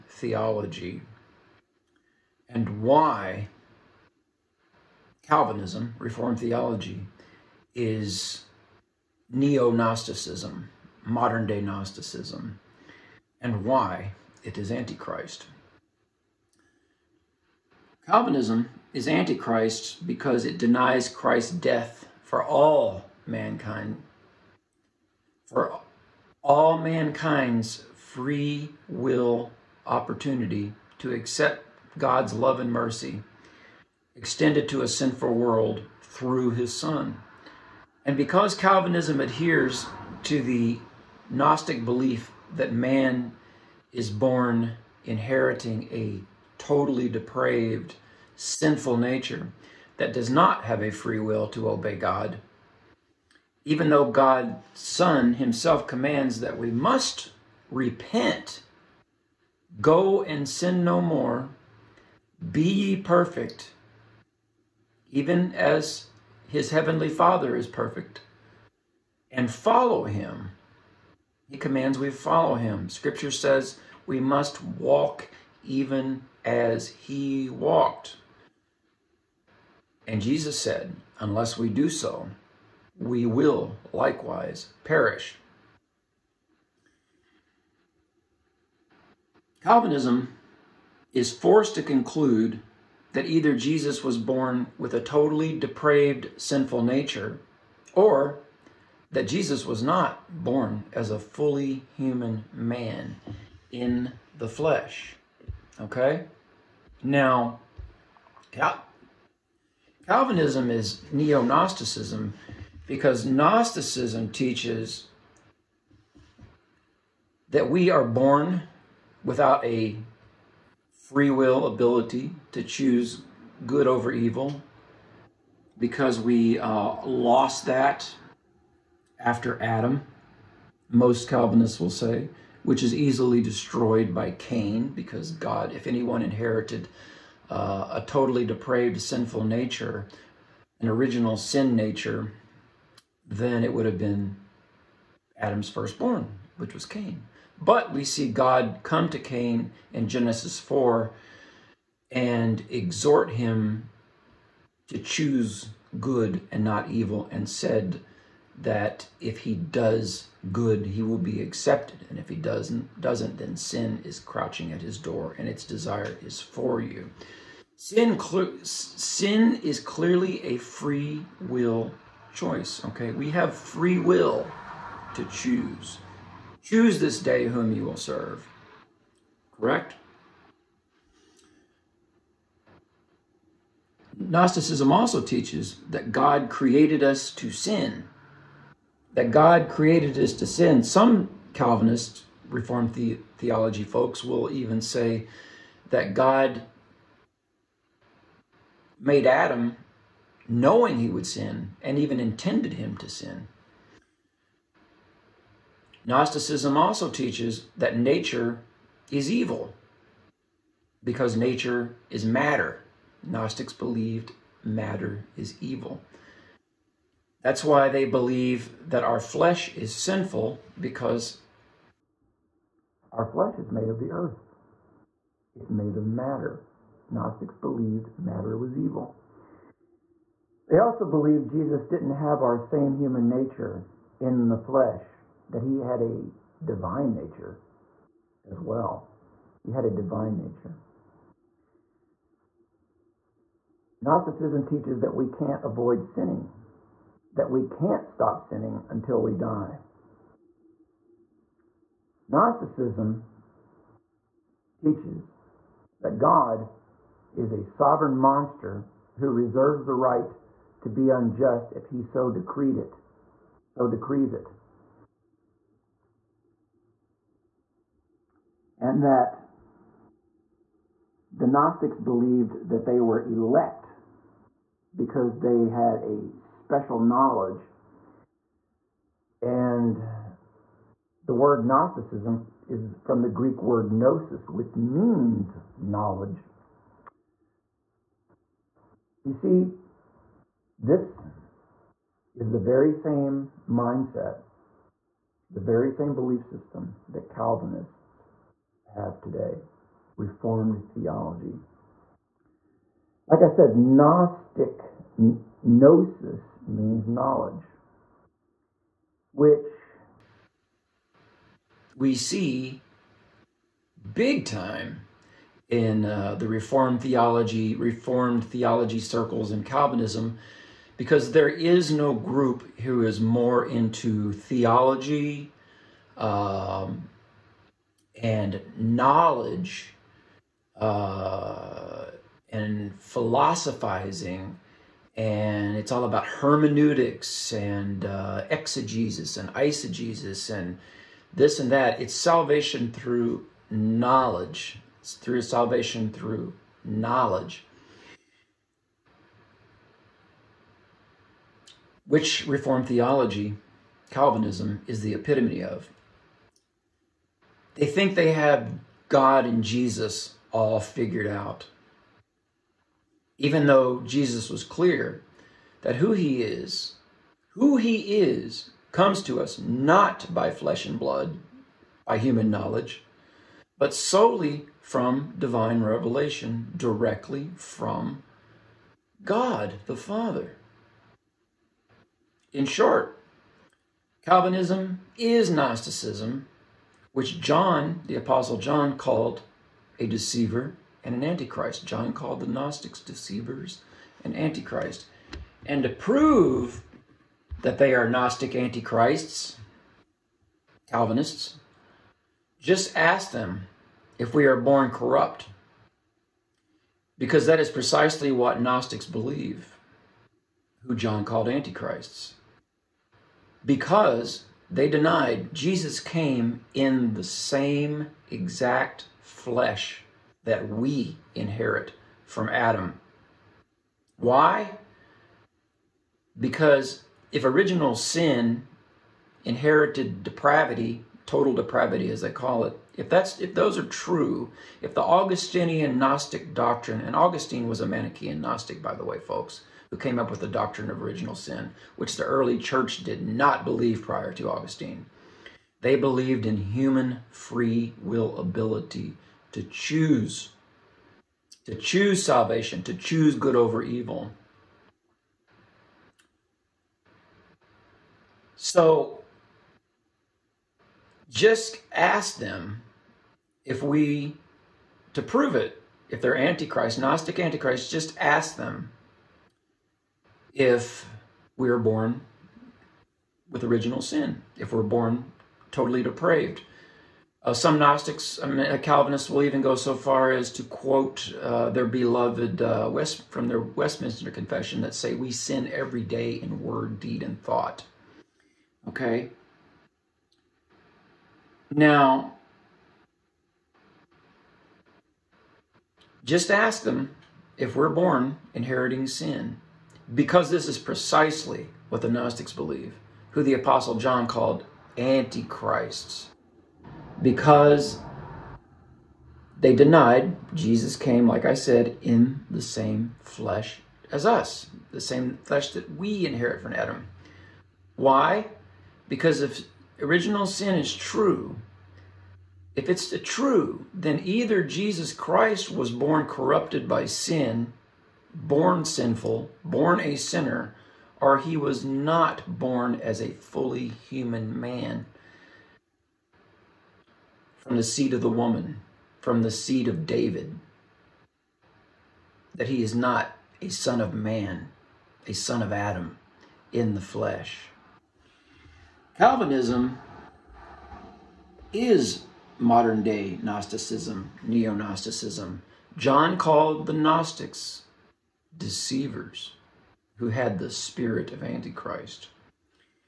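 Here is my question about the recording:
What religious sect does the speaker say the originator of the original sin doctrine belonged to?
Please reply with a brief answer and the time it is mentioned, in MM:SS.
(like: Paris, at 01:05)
Manichaean Gnostic, at 07:17.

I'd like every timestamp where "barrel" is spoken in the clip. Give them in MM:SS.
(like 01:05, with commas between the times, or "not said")
not said.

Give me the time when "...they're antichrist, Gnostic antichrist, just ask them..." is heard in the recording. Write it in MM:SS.
07:46.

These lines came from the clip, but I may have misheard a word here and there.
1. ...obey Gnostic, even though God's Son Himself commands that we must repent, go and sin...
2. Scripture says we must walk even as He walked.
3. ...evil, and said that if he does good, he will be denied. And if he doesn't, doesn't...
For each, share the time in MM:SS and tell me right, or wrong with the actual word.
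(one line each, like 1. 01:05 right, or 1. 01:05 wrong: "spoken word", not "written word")
1. 00:51 wrong: "God", not "Gnostic"
2. 01:12 right
3. 02:36 wrong: "accepted", not "denied".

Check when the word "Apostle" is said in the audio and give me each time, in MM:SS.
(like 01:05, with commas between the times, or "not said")
06:28, 08:23.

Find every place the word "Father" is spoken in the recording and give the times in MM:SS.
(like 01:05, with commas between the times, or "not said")
01:07, 06:19.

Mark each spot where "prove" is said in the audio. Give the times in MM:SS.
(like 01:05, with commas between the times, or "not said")
06:35, 07:45.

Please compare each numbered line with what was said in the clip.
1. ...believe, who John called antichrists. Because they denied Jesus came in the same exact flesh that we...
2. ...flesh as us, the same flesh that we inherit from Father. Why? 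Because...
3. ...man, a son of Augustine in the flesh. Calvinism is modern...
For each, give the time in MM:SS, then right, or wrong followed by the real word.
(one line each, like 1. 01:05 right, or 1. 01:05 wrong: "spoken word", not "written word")
1. 06:49 right
2. 08:33 wrong: "Adam", not "Father"
3. 09:04 wrong: "Adam", not "Augustine".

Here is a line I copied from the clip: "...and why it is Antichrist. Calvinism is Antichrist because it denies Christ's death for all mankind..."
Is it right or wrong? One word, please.
right.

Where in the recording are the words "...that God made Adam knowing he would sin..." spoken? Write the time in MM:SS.
03:15.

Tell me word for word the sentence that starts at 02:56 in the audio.
Choose this day whom you will serve.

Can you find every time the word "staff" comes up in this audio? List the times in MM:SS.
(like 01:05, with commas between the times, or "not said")
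not said.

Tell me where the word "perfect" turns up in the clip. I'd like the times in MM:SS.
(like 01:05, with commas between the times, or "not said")
01:02, 01:07.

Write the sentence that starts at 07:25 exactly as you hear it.
They believed in human free will ability to choose, to choose salvation, to choose good over evil.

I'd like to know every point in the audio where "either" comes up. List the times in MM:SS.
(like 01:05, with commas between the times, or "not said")
01:33, 08:44.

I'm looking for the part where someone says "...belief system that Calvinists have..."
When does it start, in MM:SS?
04:56.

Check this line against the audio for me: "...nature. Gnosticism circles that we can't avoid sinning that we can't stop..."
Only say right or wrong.
wrong.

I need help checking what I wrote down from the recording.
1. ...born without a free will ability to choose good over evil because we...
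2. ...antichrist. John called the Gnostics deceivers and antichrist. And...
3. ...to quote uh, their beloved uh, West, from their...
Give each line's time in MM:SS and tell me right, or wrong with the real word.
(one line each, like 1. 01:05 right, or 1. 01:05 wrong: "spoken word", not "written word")
1. 01:58 right
2. 06:31 right
3. 08:00 right.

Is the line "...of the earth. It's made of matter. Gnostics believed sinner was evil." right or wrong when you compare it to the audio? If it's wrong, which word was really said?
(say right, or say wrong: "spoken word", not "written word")
wrong: "matter", not "sinner".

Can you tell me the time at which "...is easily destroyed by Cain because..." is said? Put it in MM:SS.
02:12.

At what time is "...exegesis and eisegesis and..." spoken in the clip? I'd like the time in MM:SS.
05:38.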